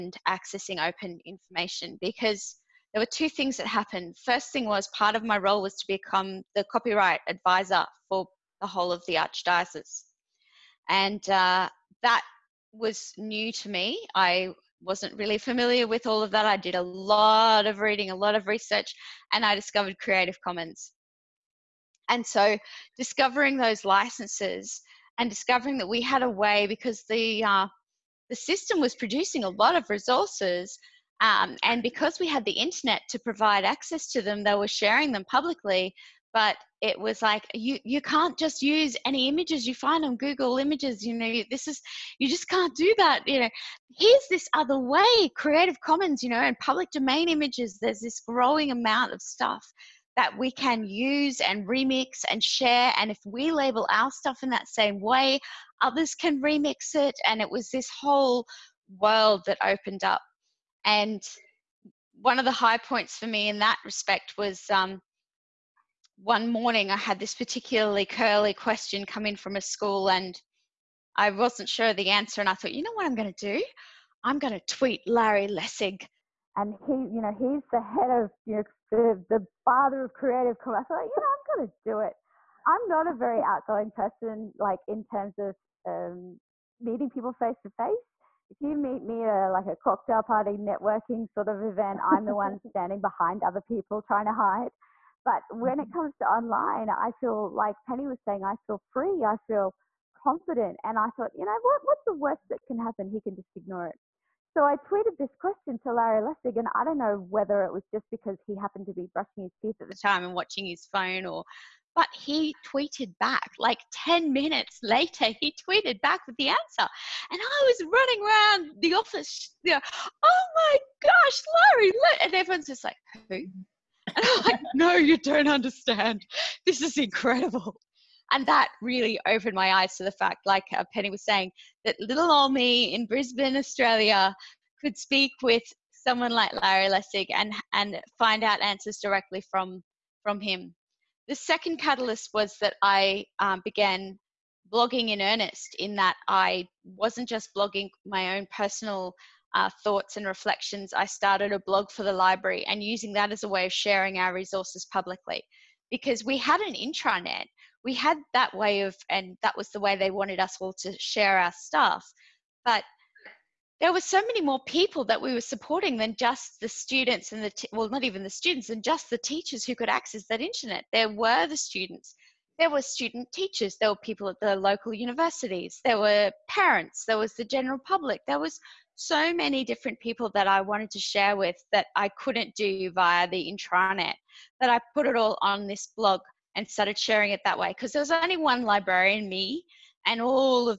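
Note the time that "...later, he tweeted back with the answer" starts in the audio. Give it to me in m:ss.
1:54.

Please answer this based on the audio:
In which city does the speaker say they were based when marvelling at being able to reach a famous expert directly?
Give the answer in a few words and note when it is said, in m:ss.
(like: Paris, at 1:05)
Brisbane, at 2:13.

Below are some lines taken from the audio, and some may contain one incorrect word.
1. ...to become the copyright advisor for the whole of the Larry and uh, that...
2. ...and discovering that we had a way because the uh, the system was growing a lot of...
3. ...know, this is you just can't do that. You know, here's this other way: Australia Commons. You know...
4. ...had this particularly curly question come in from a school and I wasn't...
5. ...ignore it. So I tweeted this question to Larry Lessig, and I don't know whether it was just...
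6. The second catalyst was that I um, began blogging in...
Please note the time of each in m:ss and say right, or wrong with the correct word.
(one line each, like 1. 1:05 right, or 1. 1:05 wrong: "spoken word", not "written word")
1. 0:05 wrong: "Archdiocese", not "Larry"
2. 0:25 wrong: "producing", not "growing"
3. 0:41 wrong: "Creative", not "Australia"
4. 1:06 right
5. 1:43 right
6. 2:21 right.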